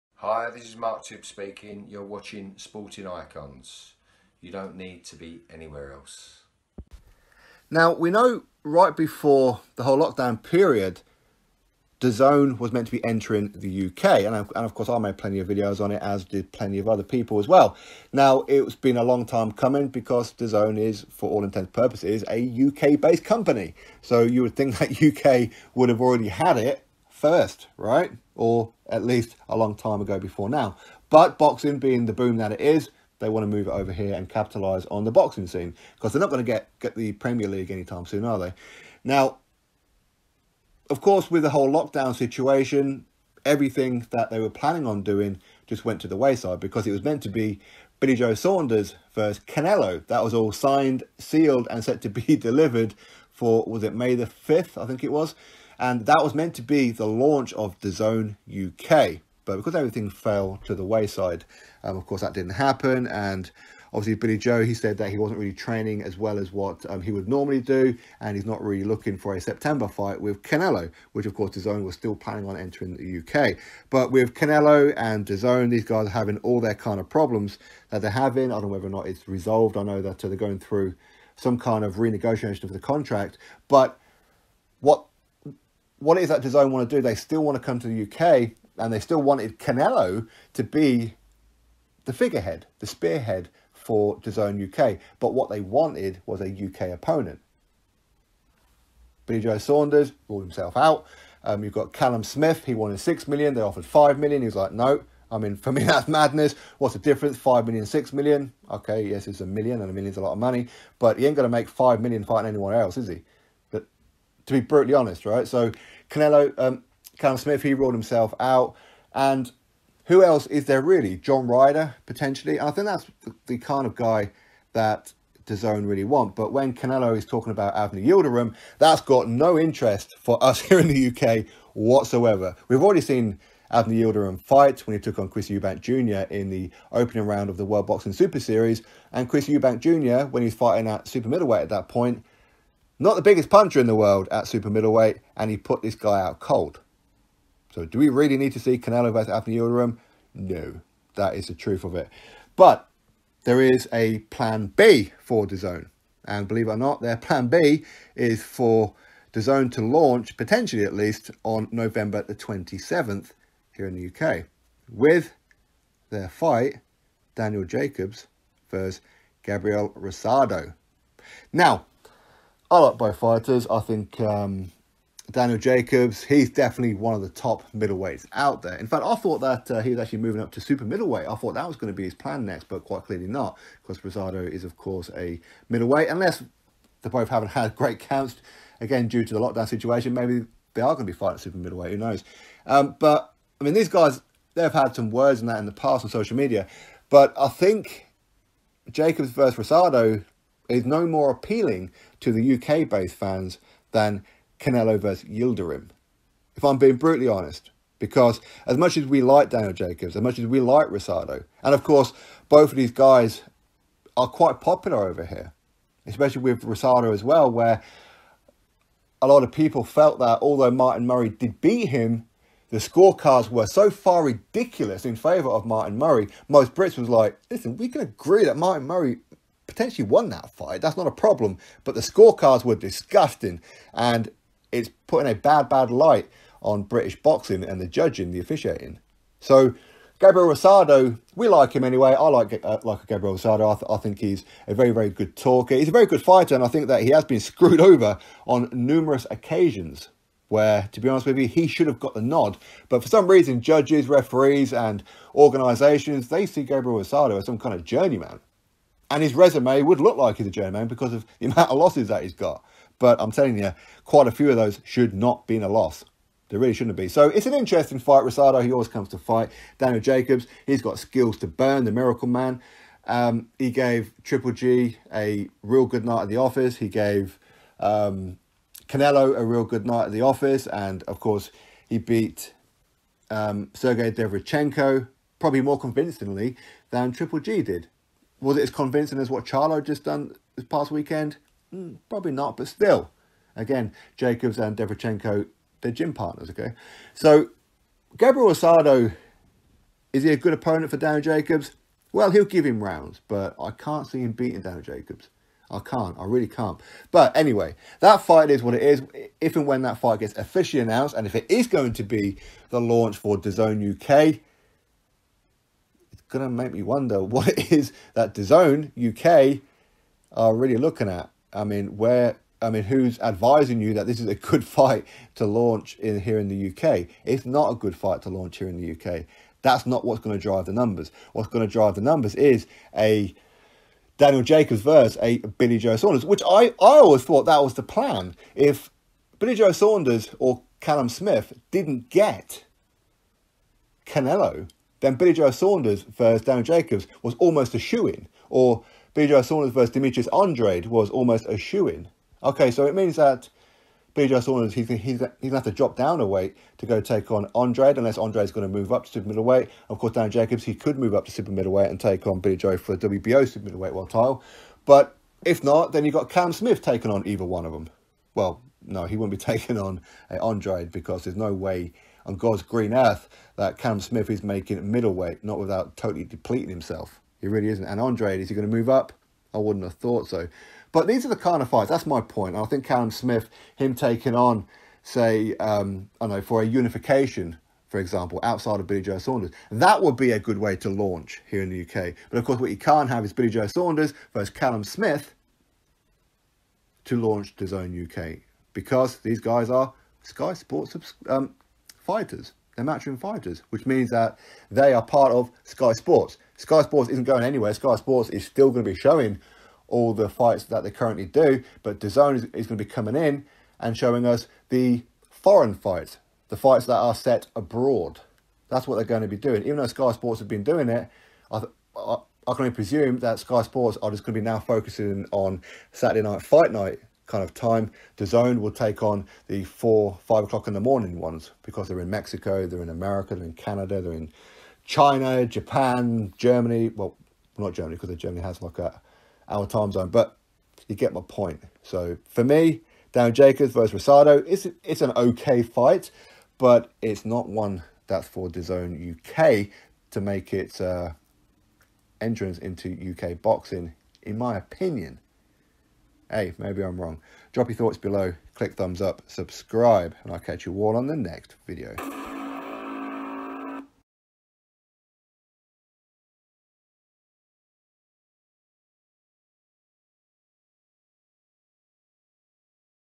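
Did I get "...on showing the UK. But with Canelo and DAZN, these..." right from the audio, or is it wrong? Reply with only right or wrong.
wrong.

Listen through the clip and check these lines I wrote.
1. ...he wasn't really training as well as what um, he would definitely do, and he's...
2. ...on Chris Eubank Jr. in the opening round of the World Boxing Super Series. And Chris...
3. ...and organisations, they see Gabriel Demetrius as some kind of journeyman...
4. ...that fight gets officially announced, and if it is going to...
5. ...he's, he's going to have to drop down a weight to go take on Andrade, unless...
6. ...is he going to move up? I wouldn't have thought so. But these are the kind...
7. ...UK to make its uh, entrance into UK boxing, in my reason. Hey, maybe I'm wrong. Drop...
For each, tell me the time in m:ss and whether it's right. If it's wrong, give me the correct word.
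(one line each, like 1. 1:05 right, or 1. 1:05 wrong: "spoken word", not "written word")
1. 1:05 wrong: "normally", not "definitely"
2. 2:15 right
3. 4:14 wrong: "Rosado", not "Demetrius"
4. 5:09 right
5. 5:54 right
6. 6:18 right
7. 7:29 wrong: "opinion", not "reason".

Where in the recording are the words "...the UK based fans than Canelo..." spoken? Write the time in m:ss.
3:22.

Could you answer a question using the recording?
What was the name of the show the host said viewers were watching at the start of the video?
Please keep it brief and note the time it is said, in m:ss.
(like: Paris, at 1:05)
Sporting Icons, at 0:02.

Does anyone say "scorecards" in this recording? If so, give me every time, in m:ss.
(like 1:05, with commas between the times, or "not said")
3:42, 3:52.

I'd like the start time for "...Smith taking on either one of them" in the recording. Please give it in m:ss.
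6:06.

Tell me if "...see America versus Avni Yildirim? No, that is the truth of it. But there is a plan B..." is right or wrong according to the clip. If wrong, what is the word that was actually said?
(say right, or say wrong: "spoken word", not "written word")
wrong: "Canelo", not "America".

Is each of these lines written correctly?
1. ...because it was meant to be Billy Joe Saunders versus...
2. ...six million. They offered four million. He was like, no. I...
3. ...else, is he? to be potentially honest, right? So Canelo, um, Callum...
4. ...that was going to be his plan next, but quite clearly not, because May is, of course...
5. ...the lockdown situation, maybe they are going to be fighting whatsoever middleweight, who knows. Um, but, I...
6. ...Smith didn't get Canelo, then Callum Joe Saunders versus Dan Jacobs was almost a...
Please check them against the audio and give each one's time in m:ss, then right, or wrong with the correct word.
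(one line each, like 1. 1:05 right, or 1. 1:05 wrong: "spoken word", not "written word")
1. 0:46 right
2. 1:42 wrong: "five", not "four"
3. 1:52 wrong: "brutally", not "potentially"
4. 3:01 wrong: "Rosado", not "May"
5. 3:09 wrong: "super", not "whatsoever"
6. 5:41 wrong: "Billy", not "Callum".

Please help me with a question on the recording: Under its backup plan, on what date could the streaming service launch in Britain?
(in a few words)
November 27th.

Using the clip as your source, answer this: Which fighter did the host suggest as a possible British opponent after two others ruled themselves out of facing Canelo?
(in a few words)
John Ryder.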